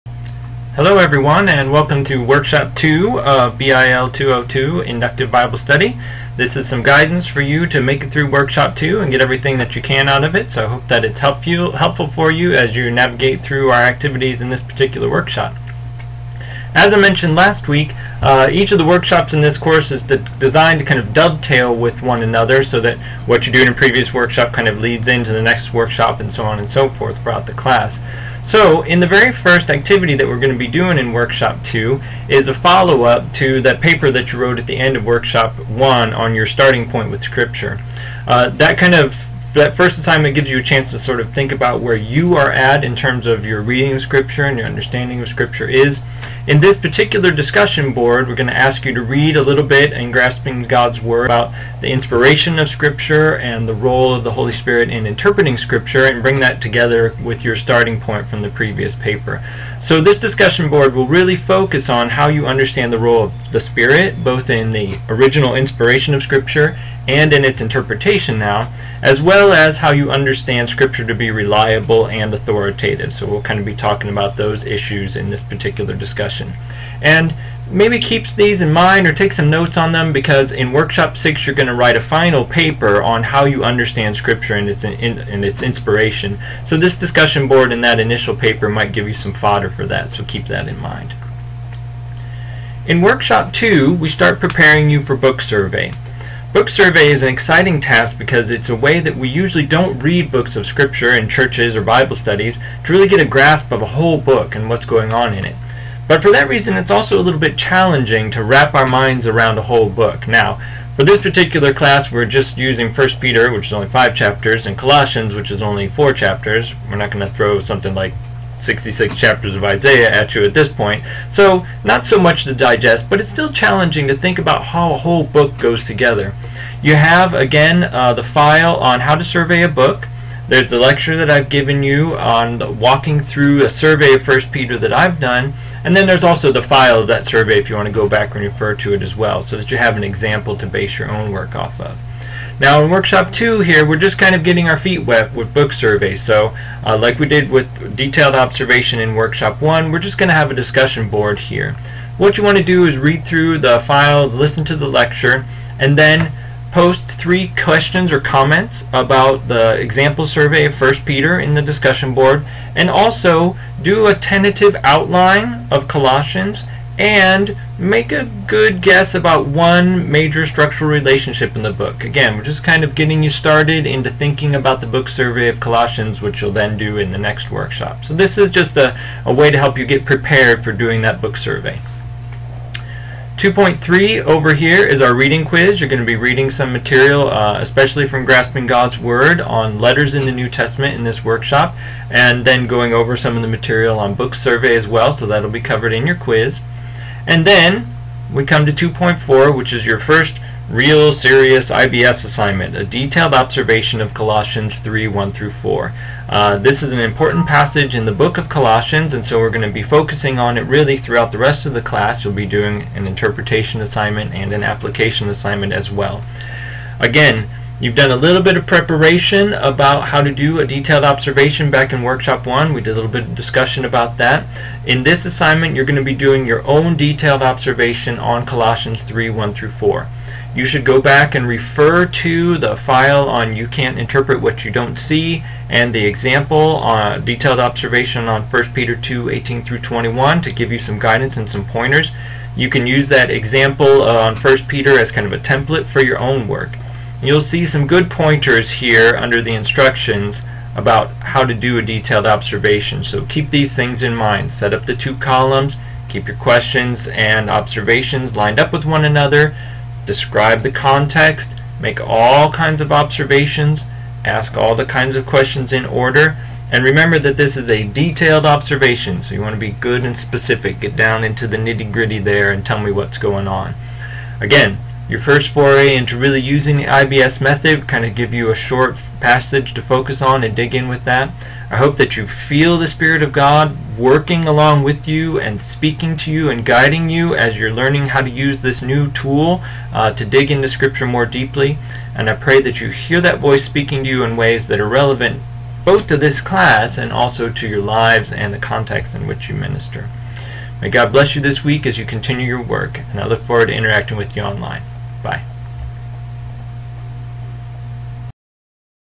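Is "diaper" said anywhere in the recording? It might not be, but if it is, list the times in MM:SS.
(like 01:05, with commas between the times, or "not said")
not said.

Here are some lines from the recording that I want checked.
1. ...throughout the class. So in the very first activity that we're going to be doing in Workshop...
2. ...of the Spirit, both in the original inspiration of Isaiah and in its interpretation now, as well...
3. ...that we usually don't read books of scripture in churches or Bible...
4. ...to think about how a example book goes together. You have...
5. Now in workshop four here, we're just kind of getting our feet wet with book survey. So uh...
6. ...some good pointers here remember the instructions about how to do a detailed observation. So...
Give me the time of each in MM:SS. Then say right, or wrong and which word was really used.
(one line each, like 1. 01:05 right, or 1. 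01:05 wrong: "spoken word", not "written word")
1. 00:27 right
2. 01:03 wrong: "Scripture", not "Isaiah"
3. 01:38 right
4. 02:04 wrong: "whole", not "example"
5. 02:22 wrong: "two", not "four"
6. 04:07 wrong: "under", not "remember".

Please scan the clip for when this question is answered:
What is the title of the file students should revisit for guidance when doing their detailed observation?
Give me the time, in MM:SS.
03:53.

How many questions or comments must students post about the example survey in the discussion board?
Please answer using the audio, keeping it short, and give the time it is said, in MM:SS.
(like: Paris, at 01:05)
3, at 02:37.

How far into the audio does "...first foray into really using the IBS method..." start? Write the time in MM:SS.
04:35.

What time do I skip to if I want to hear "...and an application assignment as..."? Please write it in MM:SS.
03:34.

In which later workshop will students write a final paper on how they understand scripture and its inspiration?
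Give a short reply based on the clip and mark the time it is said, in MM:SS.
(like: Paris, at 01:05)
Workshop 6, at 01:20.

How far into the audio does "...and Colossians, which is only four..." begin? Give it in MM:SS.
01:54.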